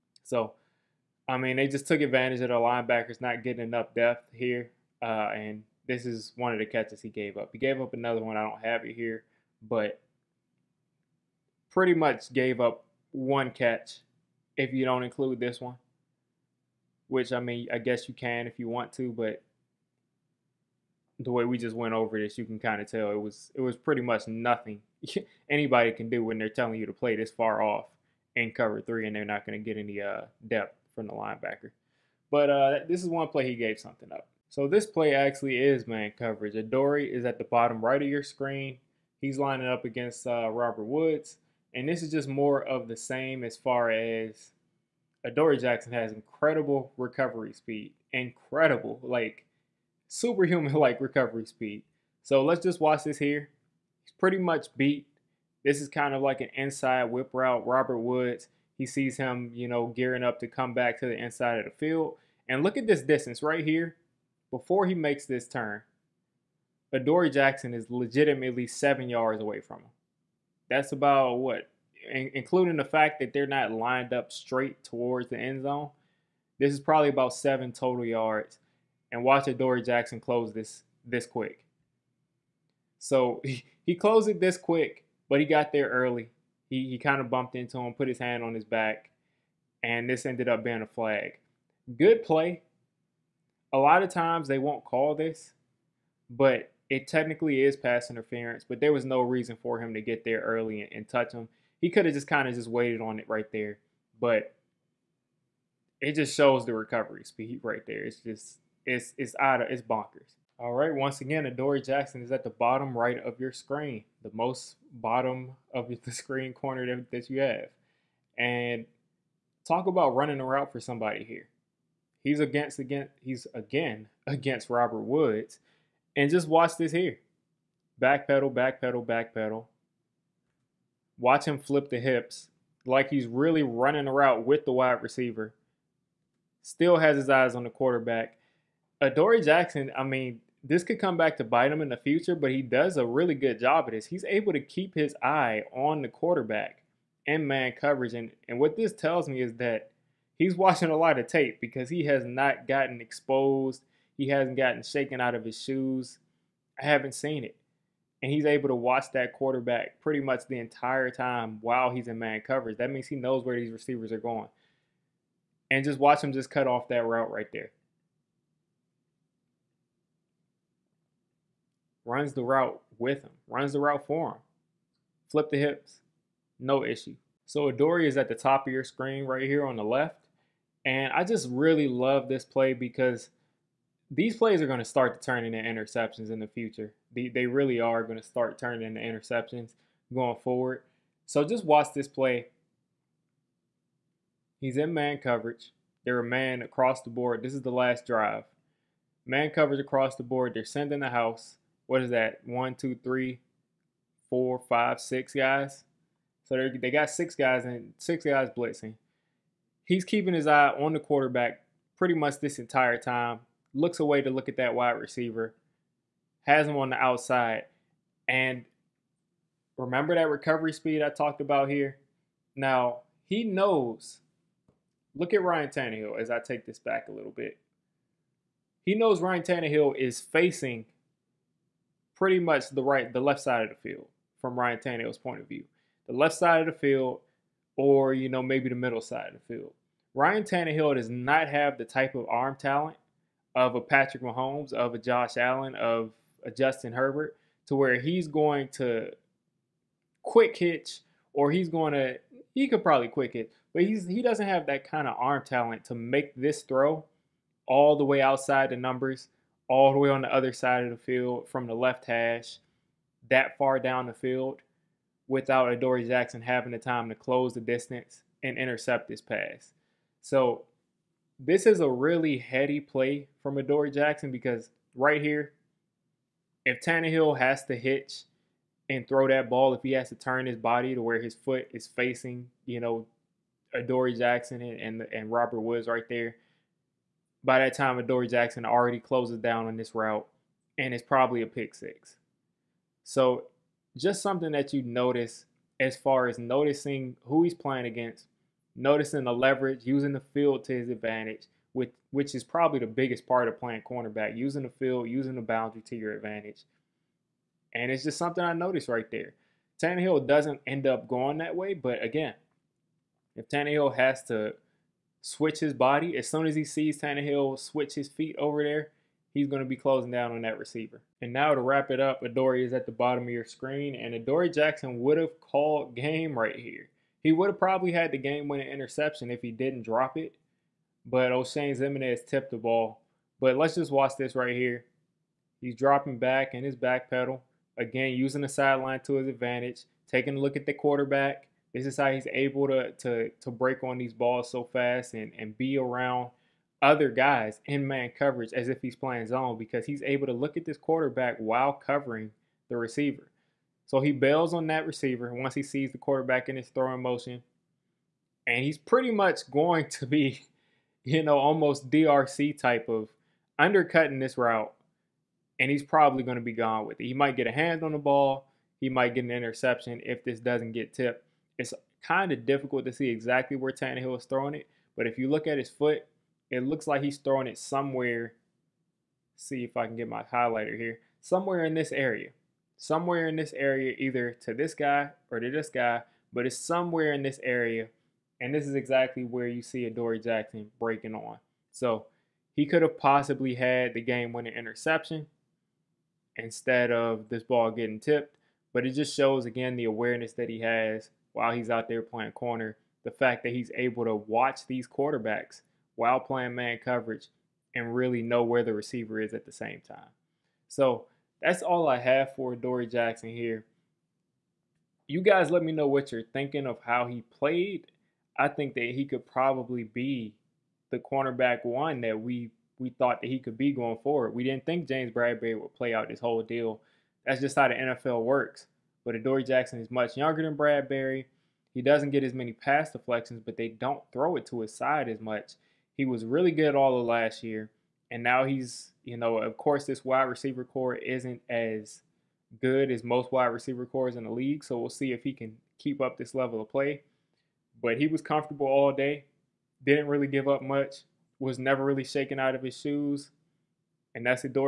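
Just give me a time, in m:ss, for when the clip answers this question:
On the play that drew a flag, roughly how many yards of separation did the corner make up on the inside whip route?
1:17.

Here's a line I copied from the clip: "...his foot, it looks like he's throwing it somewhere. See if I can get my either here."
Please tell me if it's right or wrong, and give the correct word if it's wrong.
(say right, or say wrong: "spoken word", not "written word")
wrong: "highlighter", not "either".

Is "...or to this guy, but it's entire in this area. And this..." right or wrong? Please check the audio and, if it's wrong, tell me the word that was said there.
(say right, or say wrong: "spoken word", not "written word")
wrong: "somewhere", not "entire".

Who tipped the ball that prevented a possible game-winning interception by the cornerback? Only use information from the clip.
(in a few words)
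Oshane Ximines.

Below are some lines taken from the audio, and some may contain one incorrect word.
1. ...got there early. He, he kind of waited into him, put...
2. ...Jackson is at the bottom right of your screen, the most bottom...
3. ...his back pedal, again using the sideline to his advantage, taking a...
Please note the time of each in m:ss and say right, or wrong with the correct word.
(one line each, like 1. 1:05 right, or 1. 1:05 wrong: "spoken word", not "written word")
1. 1:25 wrong: "bumped", not "waited"
2. 1:51 right
3. 5:36 right.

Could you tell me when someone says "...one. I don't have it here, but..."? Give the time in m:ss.
0:08.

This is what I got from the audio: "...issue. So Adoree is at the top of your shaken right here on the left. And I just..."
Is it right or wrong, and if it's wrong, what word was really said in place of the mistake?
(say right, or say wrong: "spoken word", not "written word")
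wrong: "screen", not "shaken".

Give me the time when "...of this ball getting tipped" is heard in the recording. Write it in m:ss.
6:36.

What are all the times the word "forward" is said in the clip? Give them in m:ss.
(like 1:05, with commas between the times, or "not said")
3:10, 7:04.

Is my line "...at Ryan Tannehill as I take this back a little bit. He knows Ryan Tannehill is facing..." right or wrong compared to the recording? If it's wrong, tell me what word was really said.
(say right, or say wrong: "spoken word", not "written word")
right.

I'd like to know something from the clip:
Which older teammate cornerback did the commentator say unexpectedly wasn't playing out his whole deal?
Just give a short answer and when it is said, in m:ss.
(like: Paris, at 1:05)
James Bradberry, at 7:04.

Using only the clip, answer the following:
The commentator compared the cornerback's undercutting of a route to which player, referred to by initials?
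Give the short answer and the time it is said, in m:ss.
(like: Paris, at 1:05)
DRC, at 6:01.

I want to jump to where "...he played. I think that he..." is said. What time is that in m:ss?
6:57.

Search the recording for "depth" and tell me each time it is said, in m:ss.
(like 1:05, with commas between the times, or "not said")
0:03, 0:30.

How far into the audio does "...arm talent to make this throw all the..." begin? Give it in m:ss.
4:15.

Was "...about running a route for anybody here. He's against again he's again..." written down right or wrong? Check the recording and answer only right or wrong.
wrong.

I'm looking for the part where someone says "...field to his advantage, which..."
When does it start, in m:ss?
5:00.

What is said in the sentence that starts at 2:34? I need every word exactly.
He hasn't gotten shaken out of his shoes.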